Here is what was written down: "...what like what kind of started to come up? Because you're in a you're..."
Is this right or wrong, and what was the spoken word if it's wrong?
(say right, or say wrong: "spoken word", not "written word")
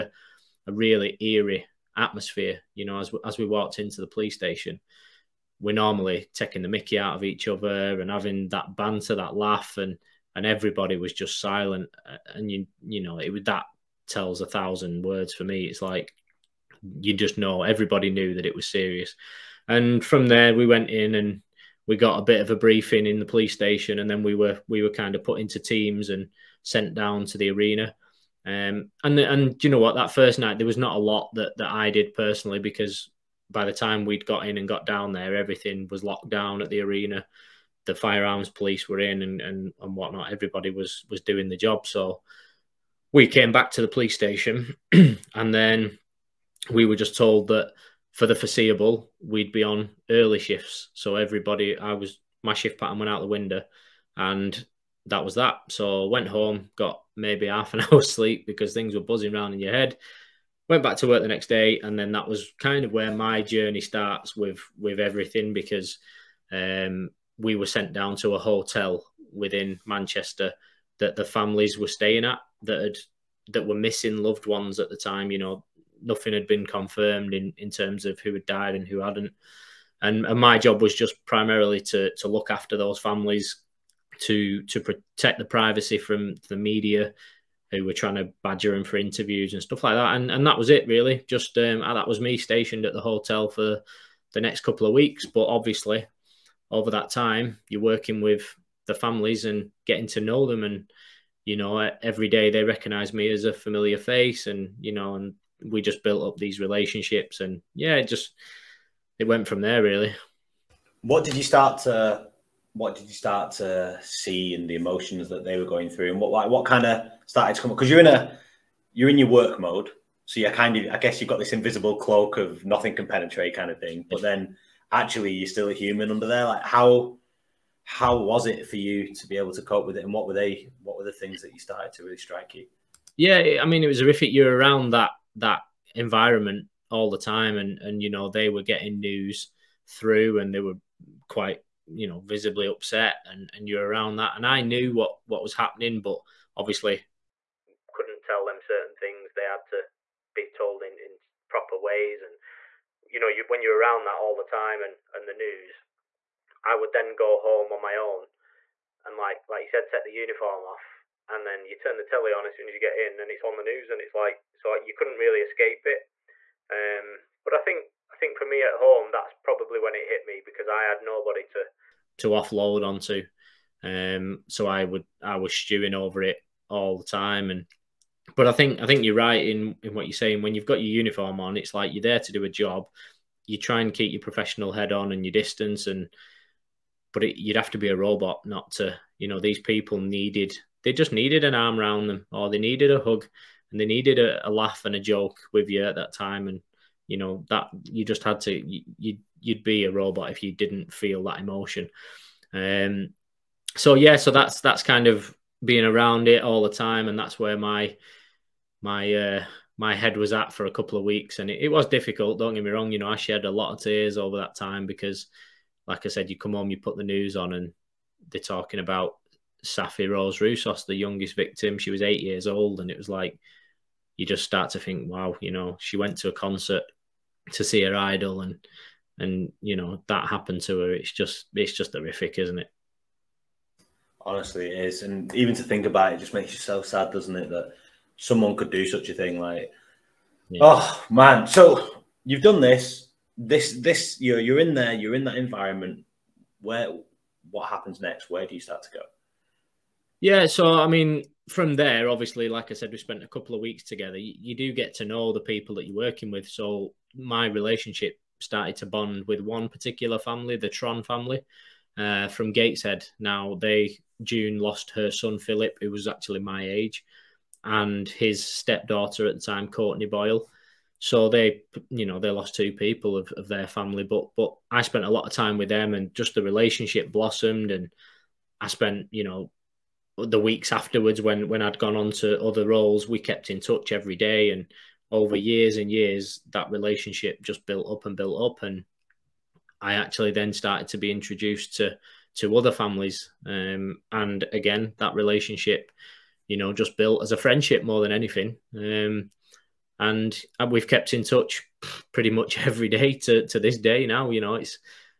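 right.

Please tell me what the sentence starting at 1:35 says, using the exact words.
But obviously, over that time, you're working with the families and getting to know them.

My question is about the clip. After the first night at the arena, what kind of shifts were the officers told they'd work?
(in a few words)
Early shifts.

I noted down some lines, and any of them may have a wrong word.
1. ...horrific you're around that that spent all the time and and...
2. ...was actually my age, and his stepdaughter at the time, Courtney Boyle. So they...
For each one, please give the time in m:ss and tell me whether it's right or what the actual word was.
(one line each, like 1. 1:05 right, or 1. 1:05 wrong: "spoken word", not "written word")
1. 2:13 wrong: "environment", not "spent"
2. 4:25 right.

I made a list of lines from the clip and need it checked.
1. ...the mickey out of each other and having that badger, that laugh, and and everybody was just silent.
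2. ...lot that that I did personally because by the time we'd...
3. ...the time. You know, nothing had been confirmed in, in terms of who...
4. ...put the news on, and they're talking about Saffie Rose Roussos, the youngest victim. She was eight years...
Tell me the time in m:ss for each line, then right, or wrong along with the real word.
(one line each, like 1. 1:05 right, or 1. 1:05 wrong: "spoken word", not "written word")
1. 0:06 wrong: "banter", not "badger"
2. 0:30 right
3. 1:14 right
4. 3:36 right.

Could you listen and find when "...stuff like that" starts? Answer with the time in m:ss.
1:29.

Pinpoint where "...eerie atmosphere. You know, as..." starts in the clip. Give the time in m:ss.
0:01.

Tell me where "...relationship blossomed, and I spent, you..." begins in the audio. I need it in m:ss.
4:36.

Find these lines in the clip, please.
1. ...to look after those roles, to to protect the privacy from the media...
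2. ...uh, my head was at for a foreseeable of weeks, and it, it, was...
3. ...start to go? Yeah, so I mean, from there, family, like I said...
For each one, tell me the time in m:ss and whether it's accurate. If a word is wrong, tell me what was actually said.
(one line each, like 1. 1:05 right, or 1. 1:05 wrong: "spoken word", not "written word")
1. 1:22 wrong: "families", not "roles"
2. 3:29 wrong: "couple", not "foreseeable"
3. 4:08 wrong: "obviously", not "family".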